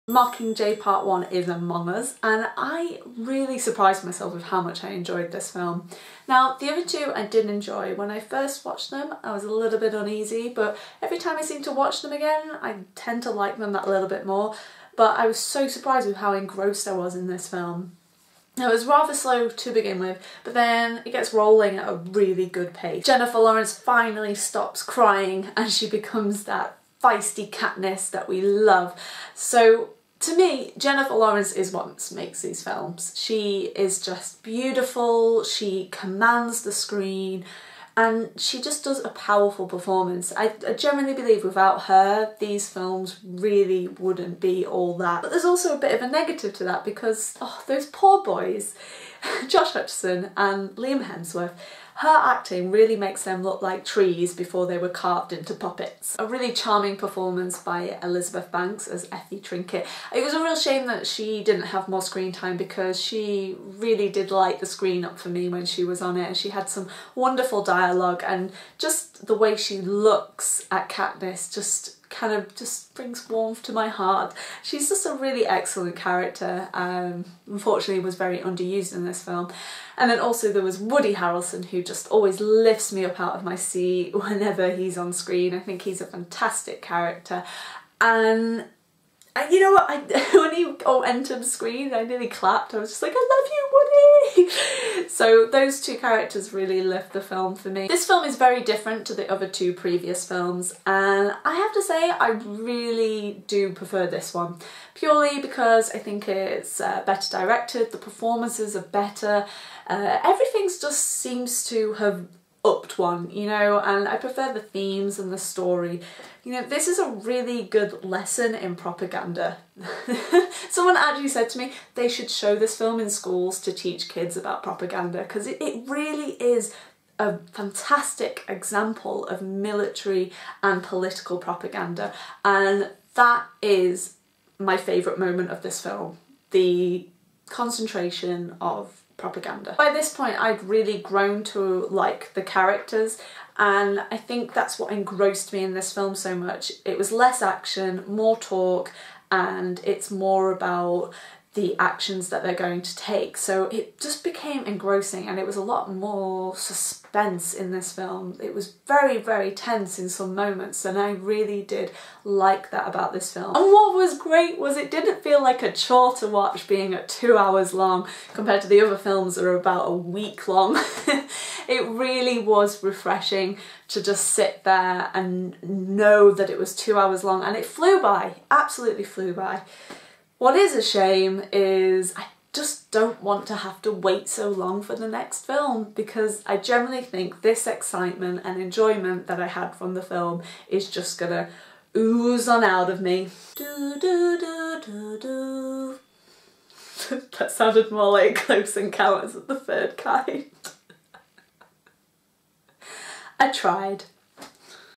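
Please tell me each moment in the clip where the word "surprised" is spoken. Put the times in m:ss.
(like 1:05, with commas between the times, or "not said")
0:03, 0:15.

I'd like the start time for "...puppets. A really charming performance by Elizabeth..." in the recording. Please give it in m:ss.
0:55.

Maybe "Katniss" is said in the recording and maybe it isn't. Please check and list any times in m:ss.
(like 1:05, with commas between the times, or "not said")
0:27, 1:10.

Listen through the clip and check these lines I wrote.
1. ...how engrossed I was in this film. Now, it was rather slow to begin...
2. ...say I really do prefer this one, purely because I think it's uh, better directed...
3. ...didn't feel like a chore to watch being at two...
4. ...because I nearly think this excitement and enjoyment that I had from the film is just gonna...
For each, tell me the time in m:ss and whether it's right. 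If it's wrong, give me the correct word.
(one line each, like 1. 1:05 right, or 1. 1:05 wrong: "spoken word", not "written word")
1. 0:16 right
2. 1:41 right
3. 2:44 right
4. 3:05 wrong: "generally", not "nearly".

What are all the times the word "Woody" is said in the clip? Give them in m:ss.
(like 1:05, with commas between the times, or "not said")
1:20, 1:34.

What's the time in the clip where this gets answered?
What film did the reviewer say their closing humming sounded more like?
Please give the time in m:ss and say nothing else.
3:18.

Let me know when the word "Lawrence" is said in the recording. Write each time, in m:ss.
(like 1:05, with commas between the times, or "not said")
0:23, 0:31.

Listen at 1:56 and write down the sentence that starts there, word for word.
You know, this is a really good lesson in propaganda.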